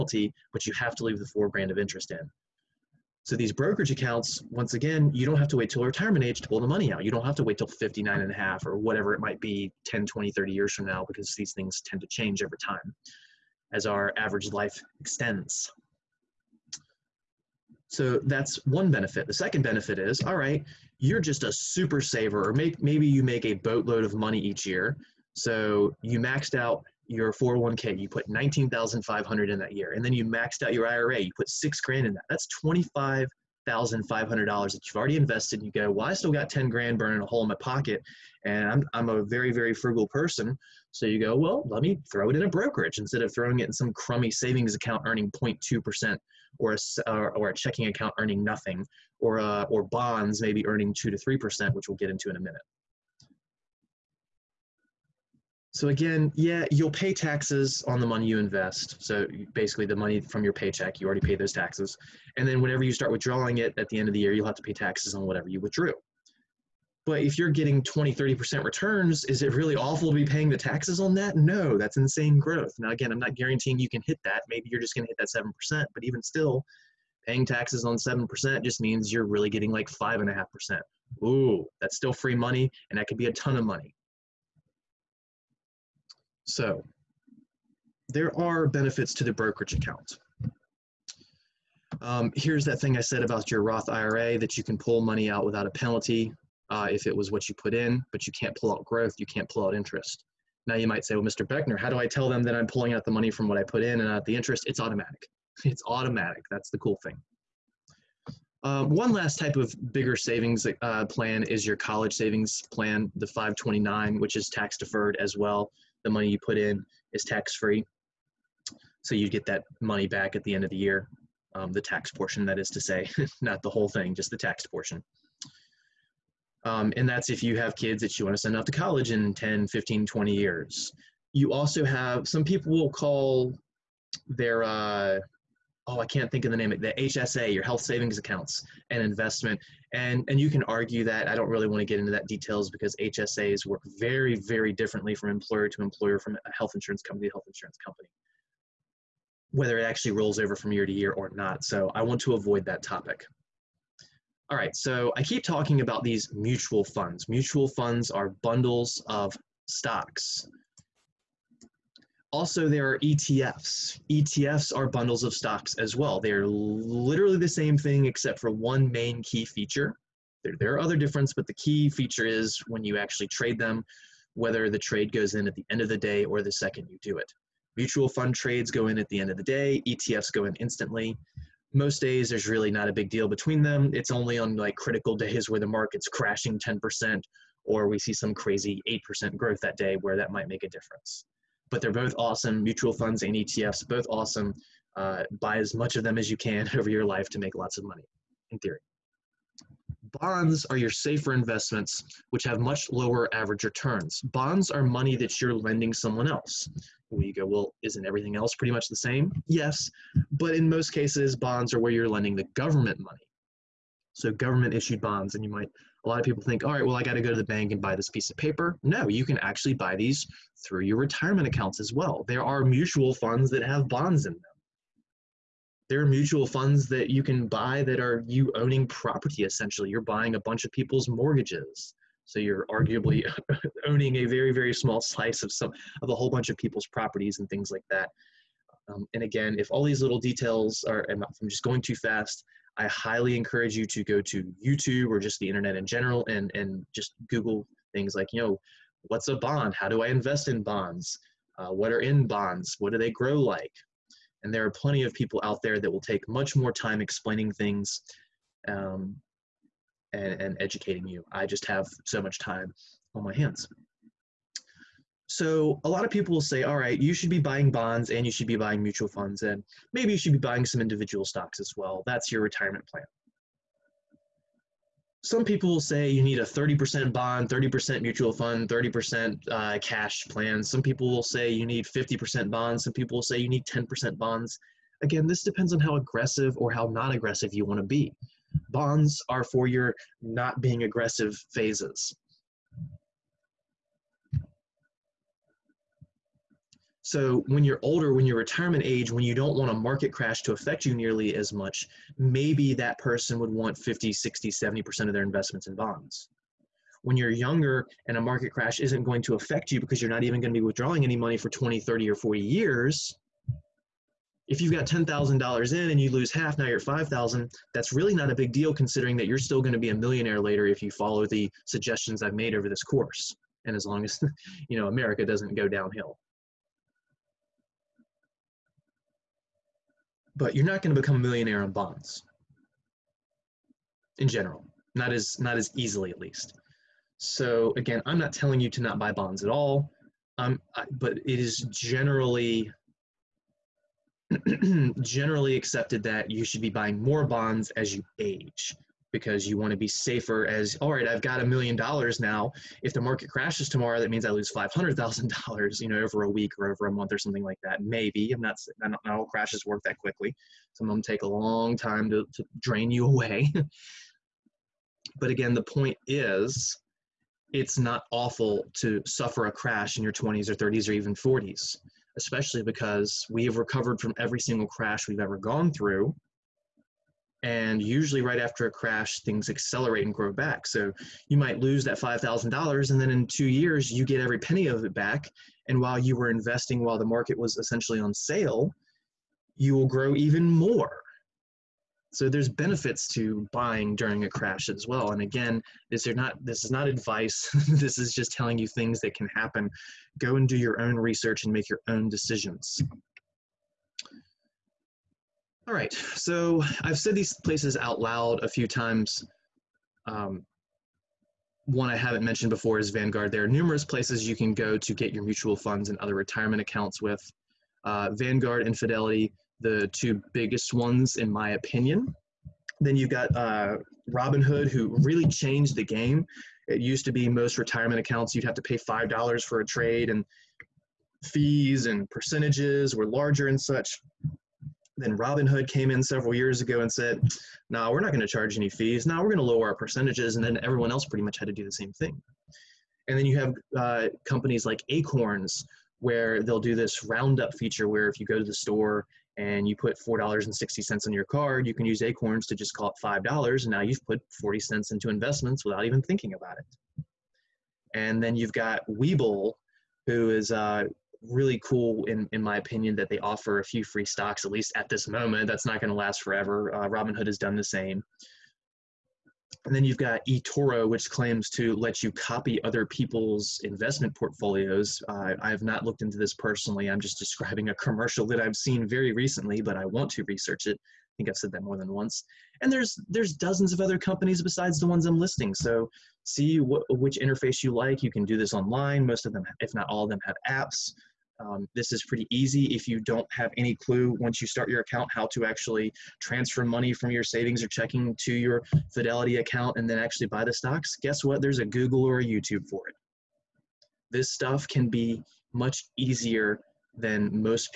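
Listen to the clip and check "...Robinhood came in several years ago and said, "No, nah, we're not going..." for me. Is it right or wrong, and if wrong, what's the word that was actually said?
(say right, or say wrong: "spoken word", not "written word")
right.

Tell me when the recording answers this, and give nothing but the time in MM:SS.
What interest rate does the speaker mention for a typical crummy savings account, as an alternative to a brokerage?
00:45.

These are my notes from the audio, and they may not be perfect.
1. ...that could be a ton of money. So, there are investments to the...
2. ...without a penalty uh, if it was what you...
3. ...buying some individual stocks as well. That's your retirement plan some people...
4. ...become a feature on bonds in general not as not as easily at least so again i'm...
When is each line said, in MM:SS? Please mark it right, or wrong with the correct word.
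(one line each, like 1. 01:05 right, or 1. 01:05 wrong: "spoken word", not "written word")
1. 01:22 wrong: "benefits", not "investments"
2. 01:35 right
3. 04:30 right
4. 05:31 wrong: "millionaire", not "feature".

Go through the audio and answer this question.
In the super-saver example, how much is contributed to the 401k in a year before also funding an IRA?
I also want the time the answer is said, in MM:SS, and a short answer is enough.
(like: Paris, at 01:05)
19,500, at 00:28.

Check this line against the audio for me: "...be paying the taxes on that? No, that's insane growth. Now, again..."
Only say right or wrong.
right.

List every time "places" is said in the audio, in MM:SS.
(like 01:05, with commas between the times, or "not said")
06:47, 06:53.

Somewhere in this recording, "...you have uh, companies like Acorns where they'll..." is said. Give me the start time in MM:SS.
07:23.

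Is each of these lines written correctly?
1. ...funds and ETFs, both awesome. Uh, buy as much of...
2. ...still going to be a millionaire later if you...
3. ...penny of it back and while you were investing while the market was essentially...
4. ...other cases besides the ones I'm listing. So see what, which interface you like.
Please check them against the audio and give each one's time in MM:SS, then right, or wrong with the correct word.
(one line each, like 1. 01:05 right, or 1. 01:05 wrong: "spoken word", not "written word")
1. 03:12 right
2. 05:19 right
3. 06:24 right
4. 08:03 wrong: "companies", not "cases".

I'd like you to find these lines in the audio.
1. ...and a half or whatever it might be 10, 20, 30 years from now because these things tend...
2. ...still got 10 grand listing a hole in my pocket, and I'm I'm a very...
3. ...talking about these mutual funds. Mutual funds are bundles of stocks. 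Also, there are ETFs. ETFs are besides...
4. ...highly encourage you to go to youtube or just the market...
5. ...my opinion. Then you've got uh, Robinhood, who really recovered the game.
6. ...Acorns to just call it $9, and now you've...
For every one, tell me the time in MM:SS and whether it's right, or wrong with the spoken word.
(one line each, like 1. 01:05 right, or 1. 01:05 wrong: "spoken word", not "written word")
1. 00:08 right
2. 00:36 wrong: "burning", not "listing"
3. 02:35 wrong: "bundles", not "besides"
4. 04:02 wrong: "internet", not "market"
5. 07:01 wrong: "changed", not "recovered"
6. 07:32 wrong: "5", not "9".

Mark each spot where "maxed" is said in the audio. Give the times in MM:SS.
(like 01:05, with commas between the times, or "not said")
00:26, 00:30.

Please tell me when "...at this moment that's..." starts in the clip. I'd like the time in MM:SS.
07:44.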